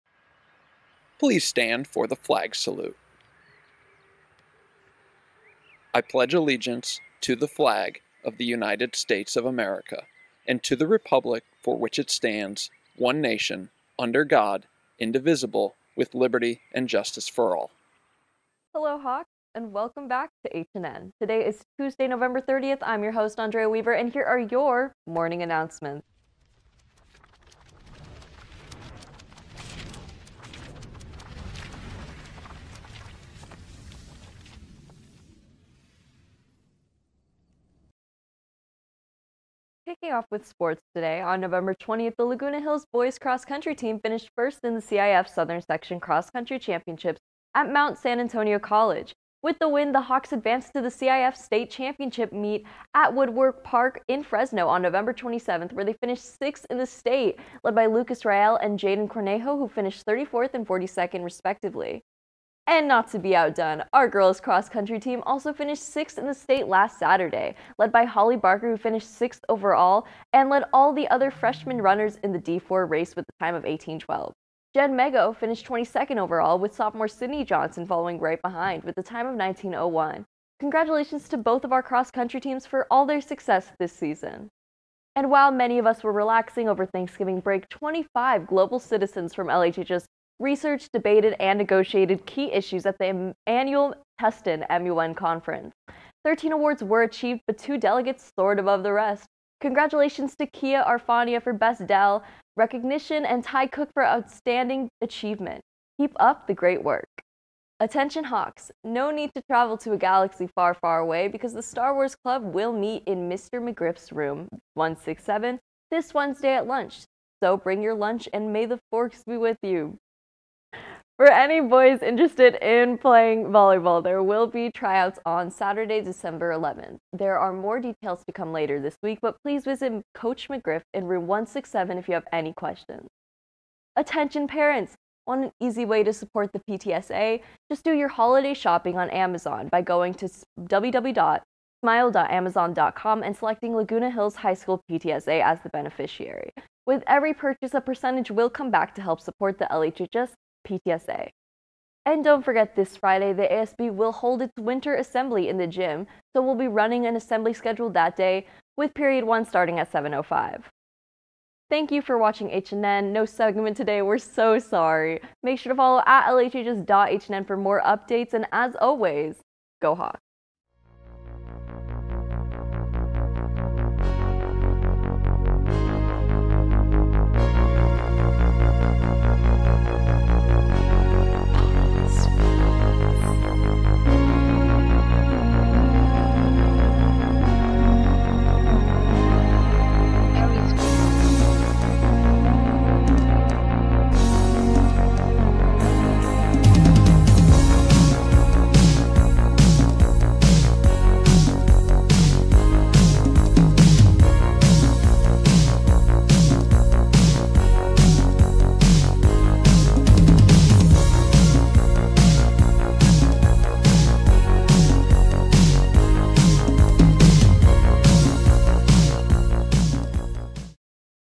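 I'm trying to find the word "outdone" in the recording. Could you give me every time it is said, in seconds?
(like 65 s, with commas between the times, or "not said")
63 s.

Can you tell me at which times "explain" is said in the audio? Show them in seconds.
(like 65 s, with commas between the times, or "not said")
not said.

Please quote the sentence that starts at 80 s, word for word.
Congratulations to both of our cross country teams for all their success this season.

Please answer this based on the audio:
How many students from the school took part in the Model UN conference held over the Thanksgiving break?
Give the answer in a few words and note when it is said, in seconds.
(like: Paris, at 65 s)
25, at 87 s.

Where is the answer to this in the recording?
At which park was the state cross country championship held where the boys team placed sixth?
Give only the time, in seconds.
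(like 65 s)
53 s.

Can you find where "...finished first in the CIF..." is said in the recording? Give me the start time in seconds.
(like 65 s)
43 s.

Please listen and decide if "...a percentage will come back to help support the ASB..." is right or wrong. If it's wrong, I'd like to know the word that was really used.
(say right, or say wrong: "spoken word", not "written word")
wrong: "LHHS", not "ASB".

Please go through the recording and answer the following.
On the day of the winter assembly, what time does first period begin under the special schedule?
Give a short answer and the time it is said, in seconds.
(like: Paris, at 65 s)
7:05, at 159 s.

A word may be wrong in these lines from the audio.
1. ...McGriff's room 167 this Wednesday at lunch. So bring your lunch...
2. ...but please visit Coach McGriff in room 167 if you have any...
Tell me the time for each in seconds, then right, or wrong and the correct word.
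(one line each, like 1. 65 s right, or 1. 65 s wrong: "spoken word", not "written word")
1. 113 s right
2. 129 s right.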